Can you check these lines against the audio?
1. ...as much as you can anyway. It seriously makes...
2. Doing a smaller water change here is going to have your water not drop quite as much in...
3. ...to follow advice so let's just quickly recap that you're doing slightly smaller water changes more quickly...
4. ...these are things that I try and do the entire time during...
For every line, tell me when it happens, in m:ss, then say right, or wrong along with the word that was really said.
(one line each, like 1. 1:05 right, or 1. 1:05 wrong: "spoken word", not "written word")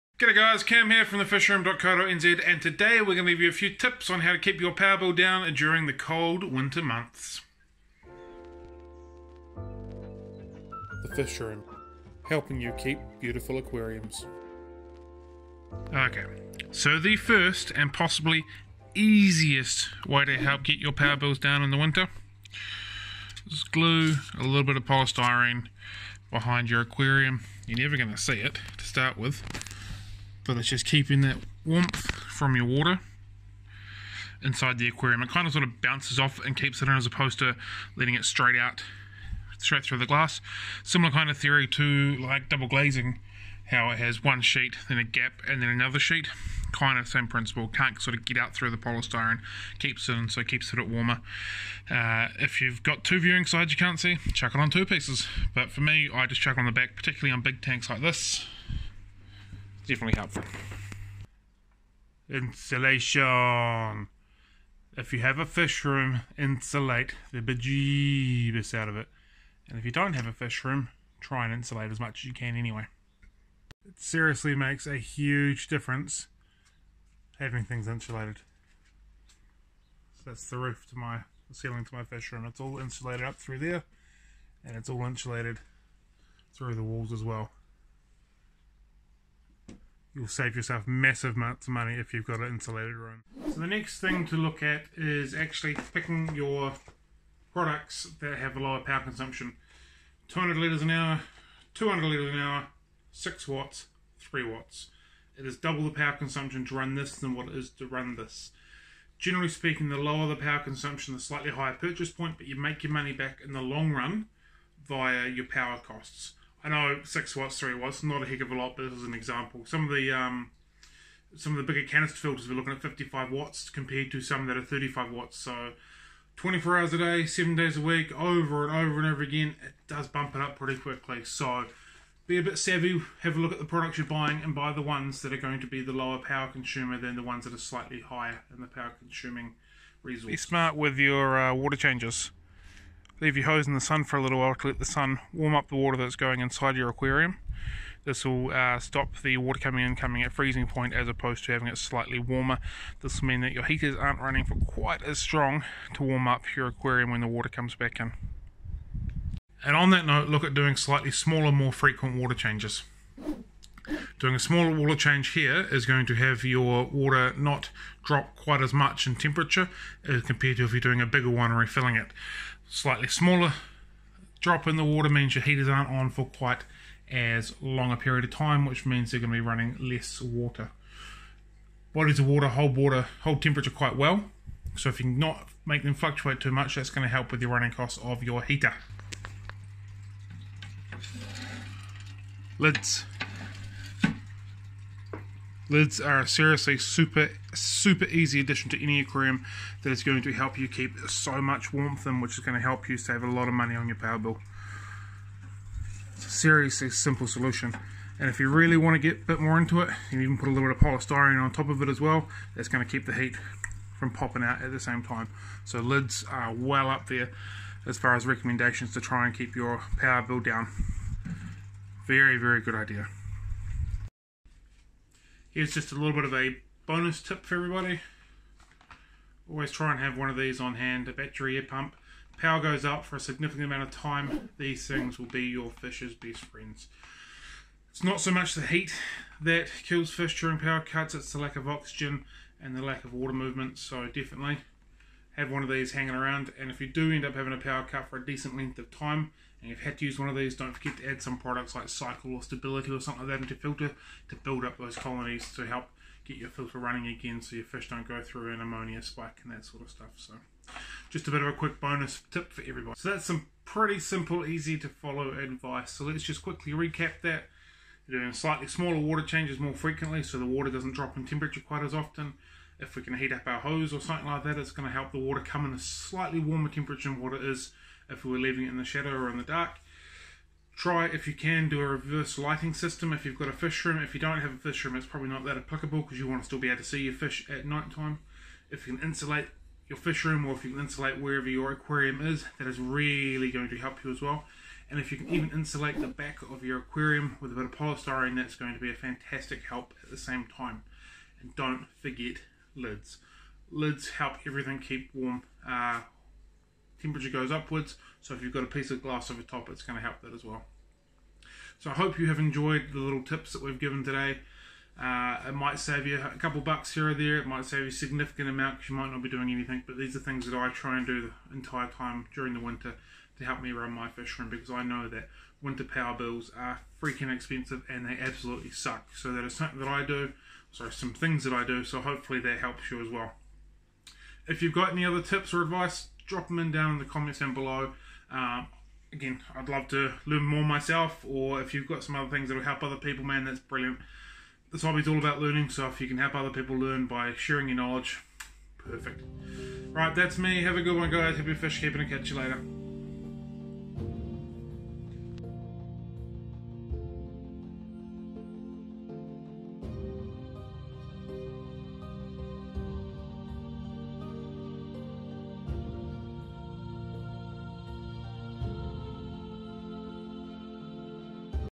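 1. 1:11 right
2. 2:44 right
3. 4:24 wrong: "frequently", not "quickly"
4. 5:19 right.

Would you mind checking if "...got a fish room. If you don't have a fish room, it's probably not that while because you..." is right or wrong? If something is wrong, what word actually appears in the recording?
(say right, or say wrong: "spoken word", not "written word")
wrong: "applicable", not "while".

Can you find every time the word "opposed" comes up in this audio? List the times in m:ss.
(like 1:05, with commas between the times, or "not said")
0:37, 2:31.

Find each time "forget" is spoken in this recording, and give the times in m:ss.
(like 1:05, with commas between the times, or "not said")
4:10, 5:02.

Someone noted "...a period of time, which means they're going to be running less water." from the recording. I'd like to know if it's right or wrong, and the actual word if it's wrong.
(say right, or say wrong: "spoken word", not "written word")
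right.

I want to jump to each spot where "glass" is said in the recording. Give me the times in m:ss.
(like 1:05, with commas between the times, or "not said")
0:40, 5:09.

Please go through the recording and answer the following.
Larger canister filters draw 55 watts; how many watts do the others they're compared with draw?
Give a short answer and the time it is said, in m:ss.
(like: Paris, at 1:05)
35 watts, at 2:04.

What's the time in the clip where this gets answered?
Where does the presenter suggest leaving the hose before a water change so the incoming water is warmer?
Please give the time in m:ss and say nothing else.
2:23.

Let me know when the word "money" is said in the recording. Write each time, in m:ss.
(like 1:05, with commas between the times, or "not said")
1:31, 1:52, 3:23.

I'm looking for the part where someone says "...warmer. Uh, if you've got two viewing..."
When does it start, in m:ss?
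0:50.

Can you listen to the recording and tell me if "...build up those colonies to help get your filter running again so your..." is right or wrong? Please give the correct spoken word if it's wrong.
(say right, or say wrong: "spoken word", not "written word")
right.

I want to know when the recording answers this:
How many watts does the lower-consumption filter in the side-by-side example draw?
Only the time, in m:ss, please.
1:44.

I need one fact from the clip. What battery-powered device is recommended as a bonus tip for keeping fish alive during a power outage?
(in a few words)
Battery air pump.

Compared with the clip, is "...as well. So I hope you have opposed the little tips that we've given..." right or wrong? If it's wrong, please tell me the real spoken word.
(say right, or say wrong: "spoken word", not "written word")
wrong: "enjoyed", not "opposed".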